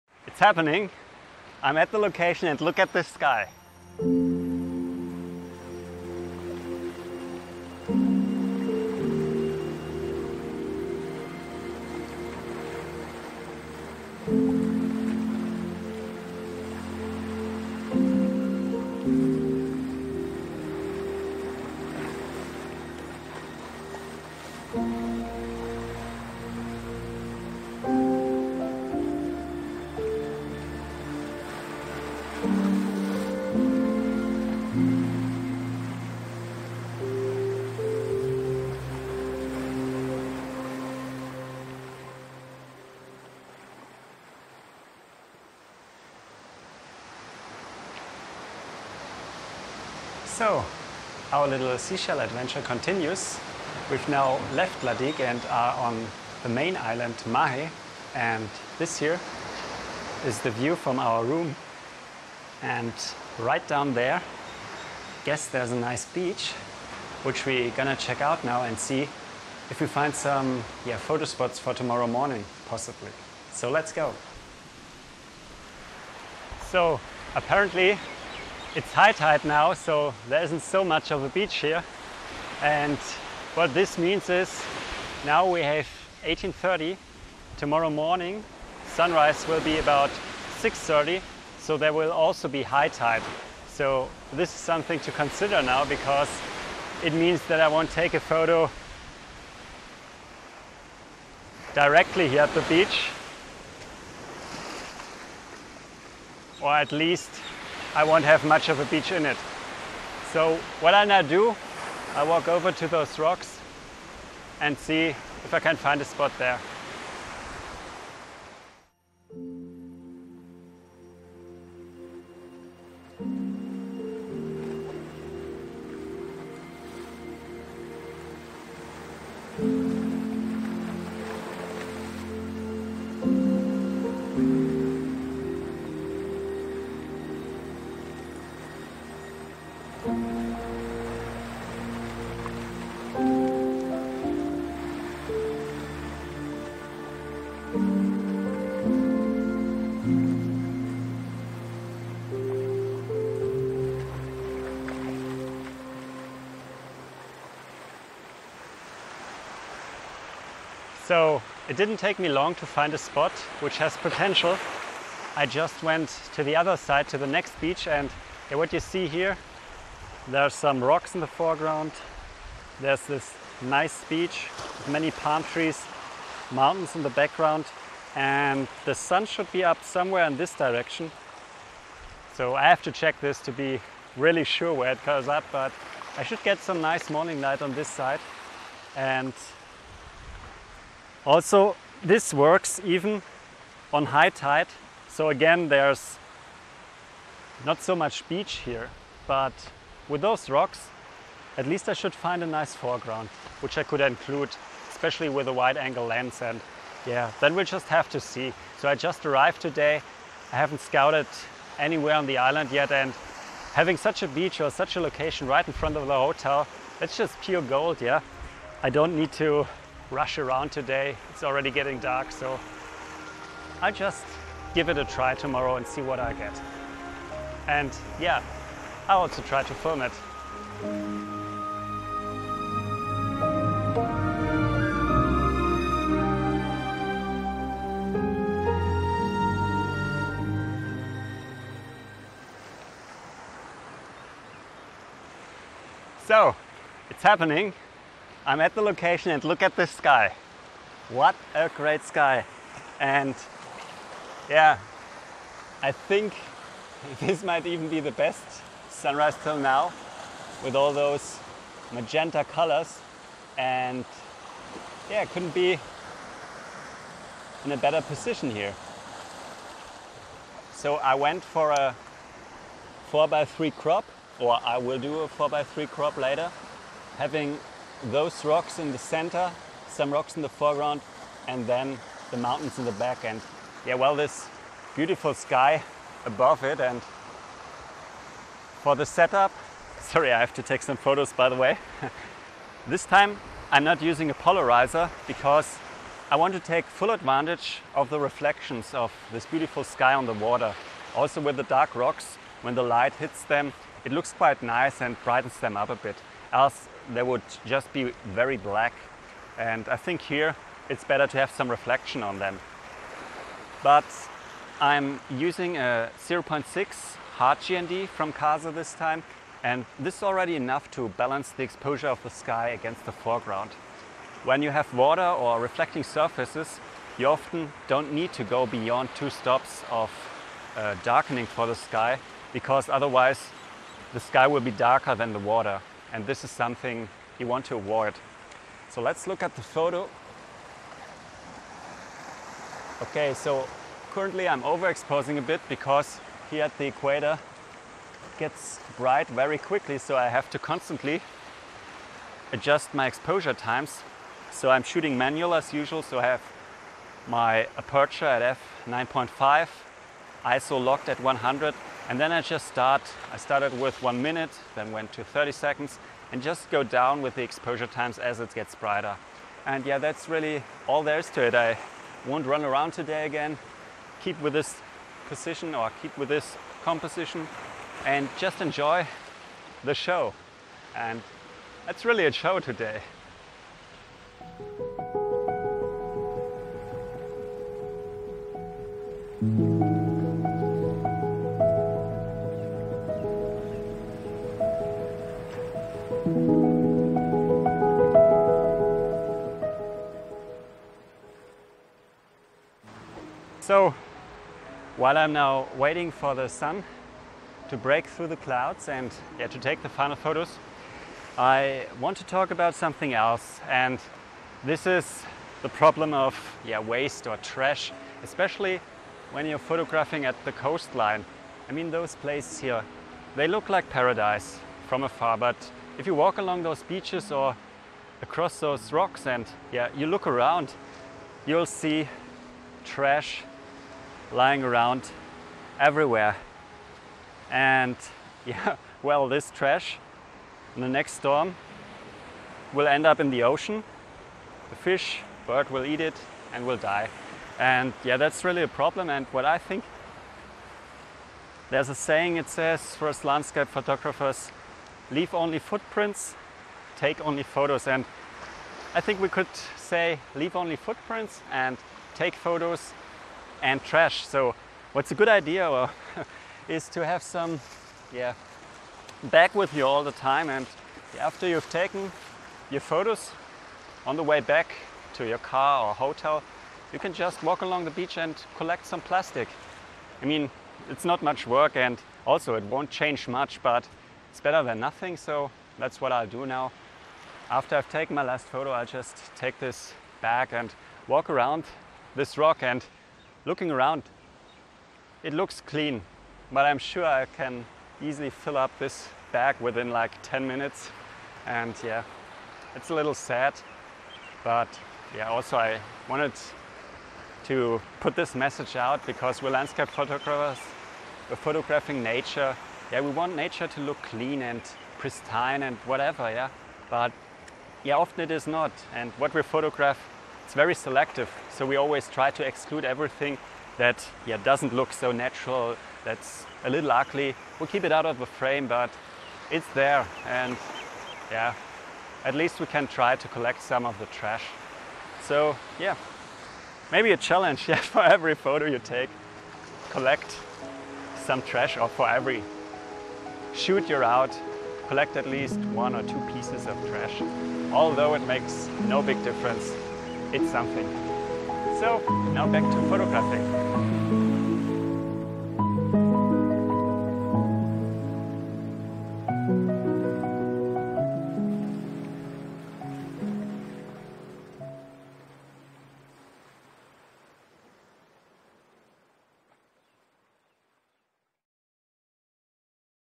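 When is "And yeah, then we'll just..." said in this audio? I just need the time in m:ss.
3:26.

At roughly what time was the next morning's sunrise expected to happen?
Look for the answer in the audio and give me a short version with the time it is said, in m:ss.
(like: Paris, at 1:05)
6:30, at 1:30.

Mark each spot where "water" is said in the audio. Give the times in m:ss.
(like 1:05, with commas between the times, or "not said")
5:00, 5:24, 5:35.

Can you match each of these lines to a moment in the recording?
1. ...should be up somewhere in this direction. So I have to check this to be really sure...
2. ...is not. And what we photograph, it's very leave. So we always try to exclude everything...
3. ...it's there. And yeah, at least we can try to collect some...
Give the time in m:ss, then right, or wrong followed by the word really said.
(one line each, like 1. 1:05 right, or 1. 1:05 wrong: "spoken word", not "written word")
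1. 2:59 right
2. 8:38 wrong: "selective", not "leave"
3. 8:49 right.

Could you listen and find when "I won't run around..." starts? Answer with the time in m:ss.
6:11.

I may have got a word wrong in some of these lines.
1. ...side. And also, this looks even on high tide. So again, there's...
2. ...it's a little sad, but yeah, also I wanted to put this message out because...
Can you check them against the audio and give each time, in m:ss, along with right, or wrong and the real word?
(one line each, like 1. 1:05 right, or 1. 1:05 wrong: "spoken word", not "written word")
1. 3:07 wrong: "works", not "looks"
2. 8:22 right.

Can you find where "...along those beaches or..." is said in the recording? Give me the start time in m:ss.
7:06.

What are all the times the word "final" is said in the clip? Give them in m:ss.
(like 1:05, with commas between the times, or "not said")
6:49.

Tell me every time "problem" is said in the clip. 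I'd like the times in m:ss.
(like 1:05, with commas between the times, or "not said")
6:55, 7:28.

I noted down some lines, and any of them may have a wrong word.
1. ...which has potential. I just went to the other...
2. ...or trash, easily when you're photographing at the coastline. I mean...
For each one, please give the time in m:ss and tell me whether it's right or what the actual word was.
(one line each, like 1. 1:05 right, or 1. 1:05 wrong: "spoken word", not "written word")
1. 2:43 right
2. 6:57 wrong: "especially", not "easily".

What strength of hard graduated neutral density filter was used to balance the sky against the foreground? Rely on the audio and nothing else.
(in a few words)
0.6.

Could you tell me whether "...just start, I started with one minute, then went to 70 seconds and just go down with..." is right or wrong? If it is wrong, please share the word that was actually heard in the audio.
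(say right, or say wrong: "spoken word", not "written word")
wrong: "30", not "70".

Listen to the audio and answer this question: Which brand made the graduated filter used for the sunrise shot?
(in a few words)
Kase.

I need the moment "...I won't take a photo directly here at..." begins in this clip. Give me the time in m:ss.
1:37.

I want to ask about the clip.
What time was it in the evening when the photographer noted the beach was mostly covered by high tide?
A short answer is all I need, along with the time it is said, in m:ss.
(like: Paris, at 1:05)
18:30, at 1:26.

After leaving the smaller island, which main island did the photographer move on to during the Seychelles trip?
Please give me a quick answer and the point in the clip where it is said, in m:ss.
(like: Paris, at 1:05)
Mahe, at 0:57.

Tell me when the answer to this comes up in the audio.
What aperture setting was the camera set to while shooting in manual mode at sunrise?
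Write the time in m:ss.
5:58.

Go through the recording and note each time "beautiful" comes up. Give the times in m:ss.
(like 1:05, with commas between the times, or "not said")
4:44, 4:59.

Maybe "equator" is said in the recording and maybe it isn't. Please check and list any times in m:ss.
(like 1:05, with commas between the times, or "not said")
5:46.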